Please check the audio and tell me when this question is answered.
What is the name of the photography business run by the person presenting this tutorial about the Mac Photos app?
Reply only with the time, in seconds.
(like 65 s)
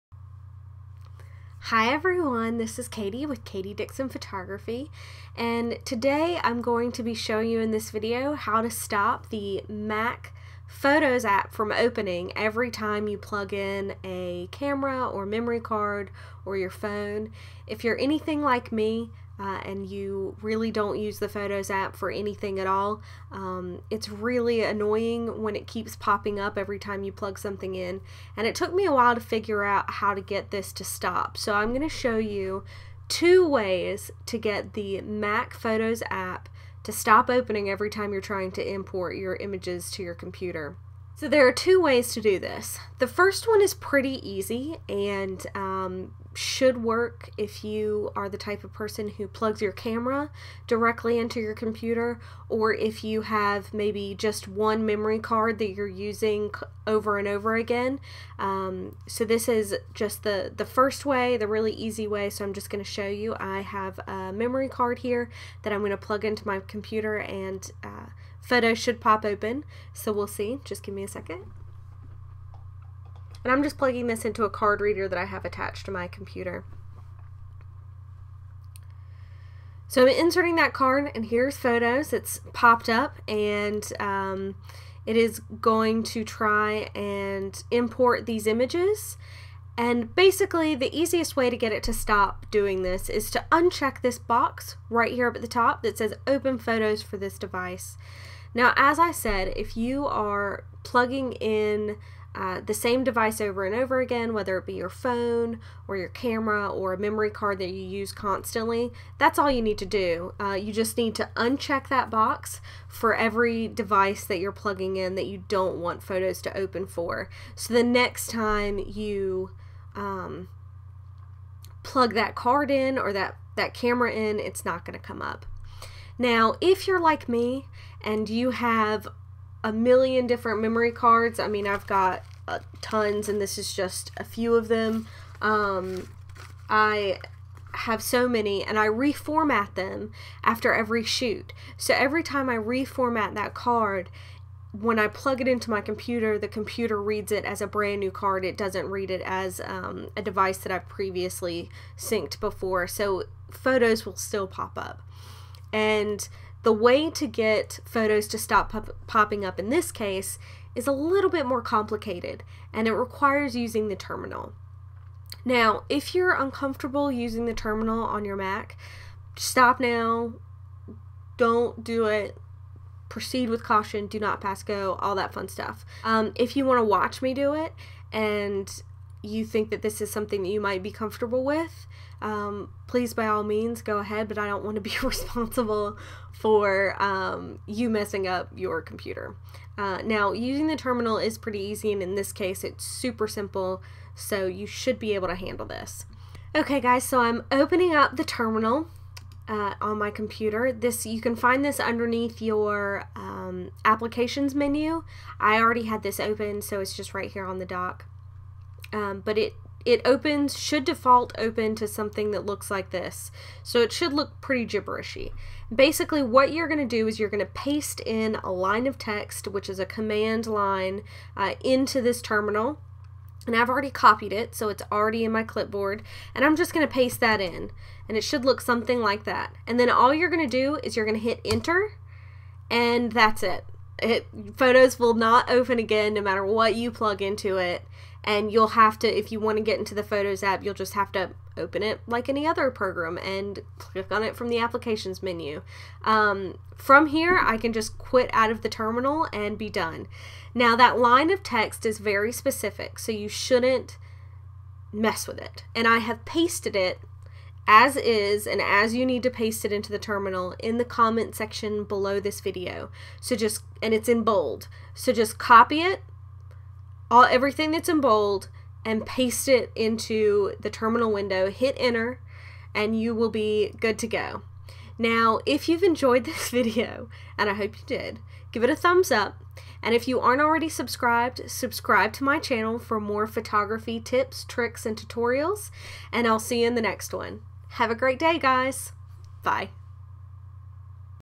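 3 s.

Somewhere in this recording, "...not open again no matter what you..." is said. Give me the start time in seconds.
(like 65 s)
235 s.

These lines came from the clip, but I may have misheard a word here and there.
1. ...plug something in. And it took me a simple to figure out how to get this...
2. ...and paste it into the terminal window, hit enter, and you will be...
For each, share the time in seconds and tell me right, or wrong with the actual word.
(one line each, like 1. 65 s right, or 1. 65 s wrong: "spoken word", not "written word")
1. 27 s wrong: "while", not "simple"
2. 268 s right.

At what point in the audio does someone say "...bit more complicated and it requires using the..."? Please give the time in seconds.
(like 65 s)
161 s.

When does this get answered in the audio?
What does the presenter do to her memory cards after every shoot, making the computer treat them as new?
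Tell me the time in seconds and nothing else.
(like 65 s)
138 s.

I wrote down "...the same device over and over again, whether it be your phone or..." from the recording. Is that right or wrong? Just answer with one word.
right.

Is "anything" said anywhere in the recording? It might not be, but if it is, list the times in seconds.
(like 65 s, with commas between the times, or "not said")
17 s, 22 s.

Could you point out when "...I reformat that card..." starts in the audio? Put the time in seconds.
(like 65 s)
142 s.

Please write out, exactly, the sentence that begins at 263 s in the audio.
So just, and it's in bold.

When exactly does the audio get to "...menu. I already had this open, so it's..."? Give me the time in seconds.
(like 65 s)
204 s.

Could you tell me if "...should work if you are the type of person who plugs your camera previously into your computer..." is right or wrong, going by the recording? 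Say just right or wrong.
wrong.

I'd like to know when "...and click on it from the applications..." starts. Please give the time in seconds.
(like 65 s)
243 s.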